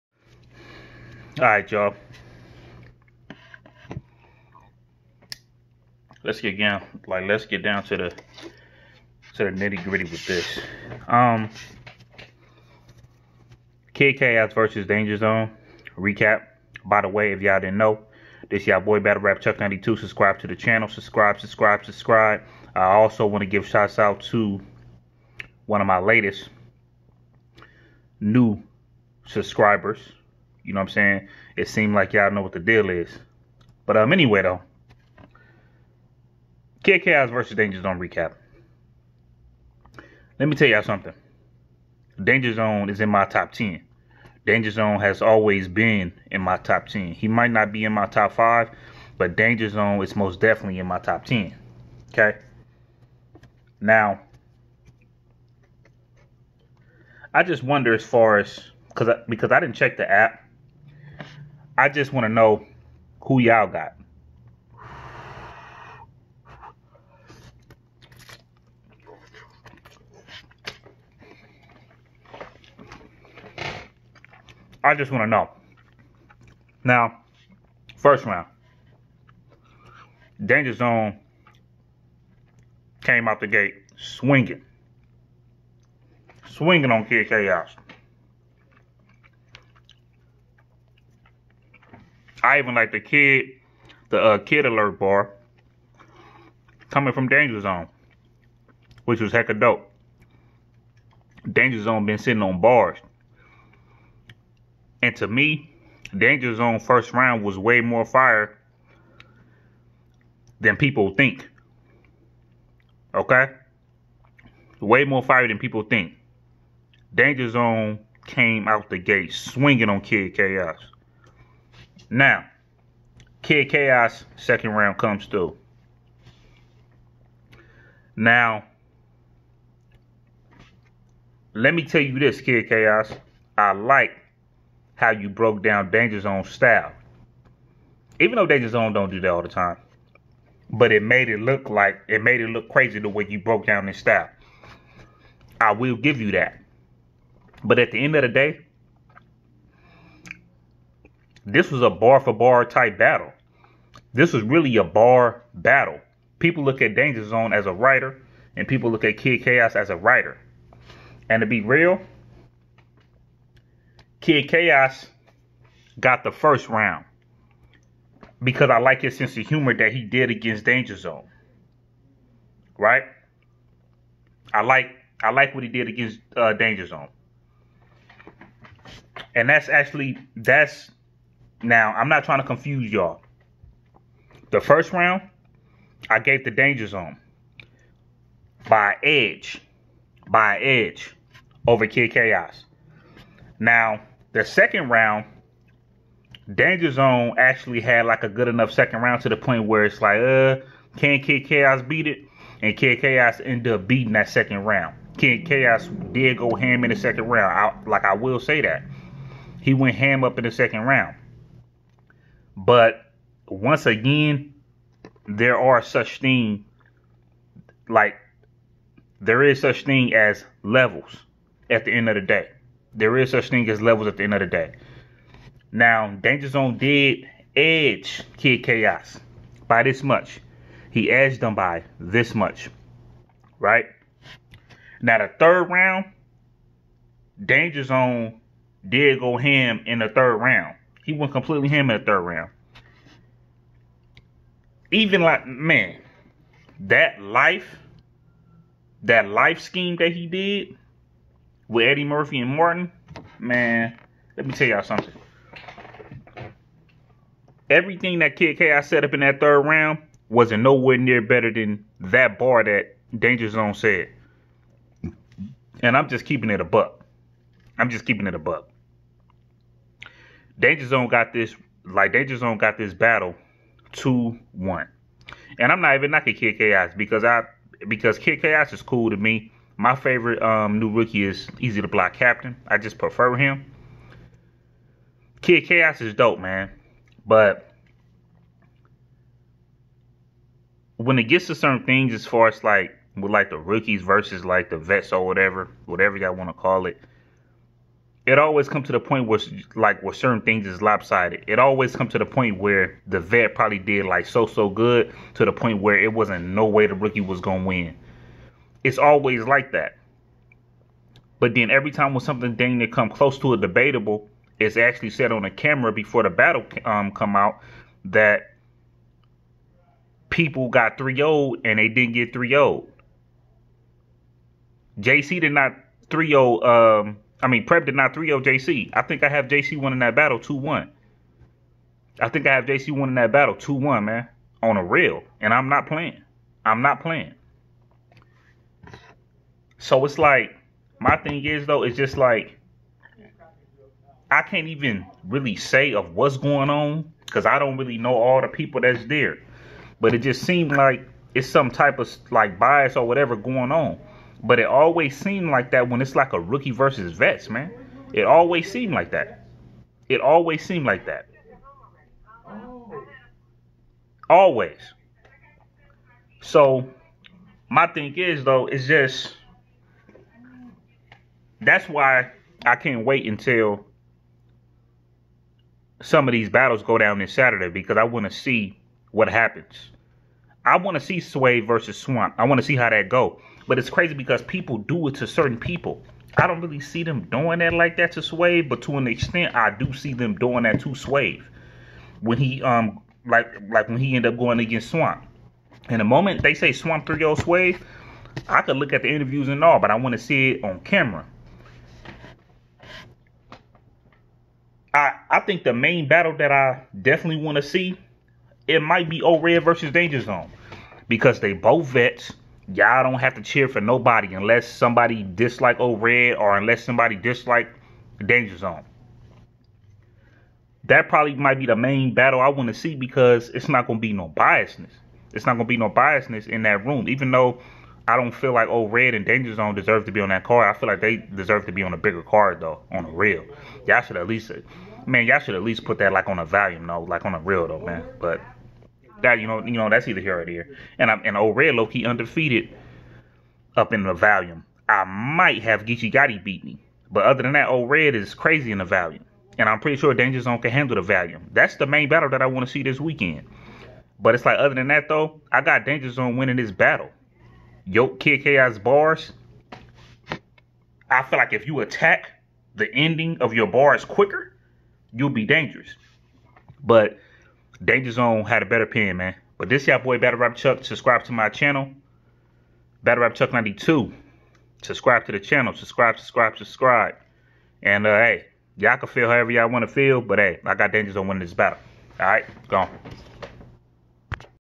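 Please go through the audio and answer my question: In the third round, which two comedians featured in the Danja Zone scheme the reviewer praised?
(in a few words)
Eddie Murphy and Martin.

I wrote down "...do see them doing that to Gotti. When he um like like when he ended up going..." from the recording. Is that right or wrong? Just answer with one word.
wrong.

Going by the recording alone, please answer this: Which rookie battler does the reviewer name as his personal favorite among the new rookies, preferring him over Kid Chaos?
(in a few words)
Eazy the Block Captain.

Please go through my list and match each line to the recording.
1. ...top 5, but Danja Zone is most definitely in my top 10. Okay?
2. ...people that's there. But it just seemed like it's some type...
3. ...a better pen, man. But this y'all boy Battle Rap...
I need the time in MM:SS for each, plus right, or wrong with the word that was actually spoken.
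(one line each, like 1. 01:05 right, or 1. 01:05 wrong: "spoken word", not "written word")
1. 00:48 right
2. 05:48 right
3. 07:48 right.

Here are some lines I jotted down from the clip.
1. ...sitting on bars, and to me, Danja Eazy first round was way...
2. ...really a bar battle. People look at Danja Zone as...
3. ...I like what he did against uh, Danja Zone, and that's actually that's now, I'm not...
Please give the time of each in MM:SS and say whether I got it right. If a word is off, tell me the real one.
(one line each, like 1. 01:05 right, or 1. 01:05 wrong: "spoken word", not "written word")
1. 01:42 wrong: "Zone", not "Eazy"
2. 02:34 right
3. 02:55 right.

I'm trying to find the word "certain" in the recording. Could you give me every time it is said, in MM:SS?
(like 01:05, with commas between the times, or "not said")
04:51, 05:00, 06:25.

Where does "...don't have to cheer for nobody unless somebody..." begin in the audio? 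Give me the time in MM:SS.
06:53.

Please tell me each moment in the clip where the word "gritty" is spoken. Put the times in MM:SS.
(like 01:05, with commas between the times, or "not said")
00:09.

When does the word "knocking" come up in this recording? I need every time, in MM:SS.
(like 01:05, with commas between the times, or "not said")
04:36.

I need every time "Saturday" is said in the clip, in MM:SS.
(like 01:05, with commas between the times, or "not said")
06:17.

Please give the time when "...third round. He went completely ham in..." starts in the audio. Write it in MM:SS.
04:00.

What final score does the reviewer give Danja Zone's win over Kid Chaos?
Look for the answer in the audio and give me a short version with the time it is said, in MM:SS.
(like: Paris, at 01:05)
2-1, at 04:33.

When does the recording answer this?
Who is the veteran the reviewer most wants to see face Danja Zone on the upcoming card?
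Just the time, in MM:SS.
06:49.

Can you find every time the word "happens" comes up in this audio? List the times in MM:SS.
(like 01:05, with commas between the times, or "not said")
06:19.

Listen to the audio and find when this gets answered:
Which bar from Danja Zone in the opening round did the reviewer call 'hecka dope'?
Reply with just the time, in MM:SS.
01:34.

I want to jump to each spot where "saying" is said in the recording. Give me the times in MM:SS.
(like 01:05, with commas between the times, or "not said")
00:30.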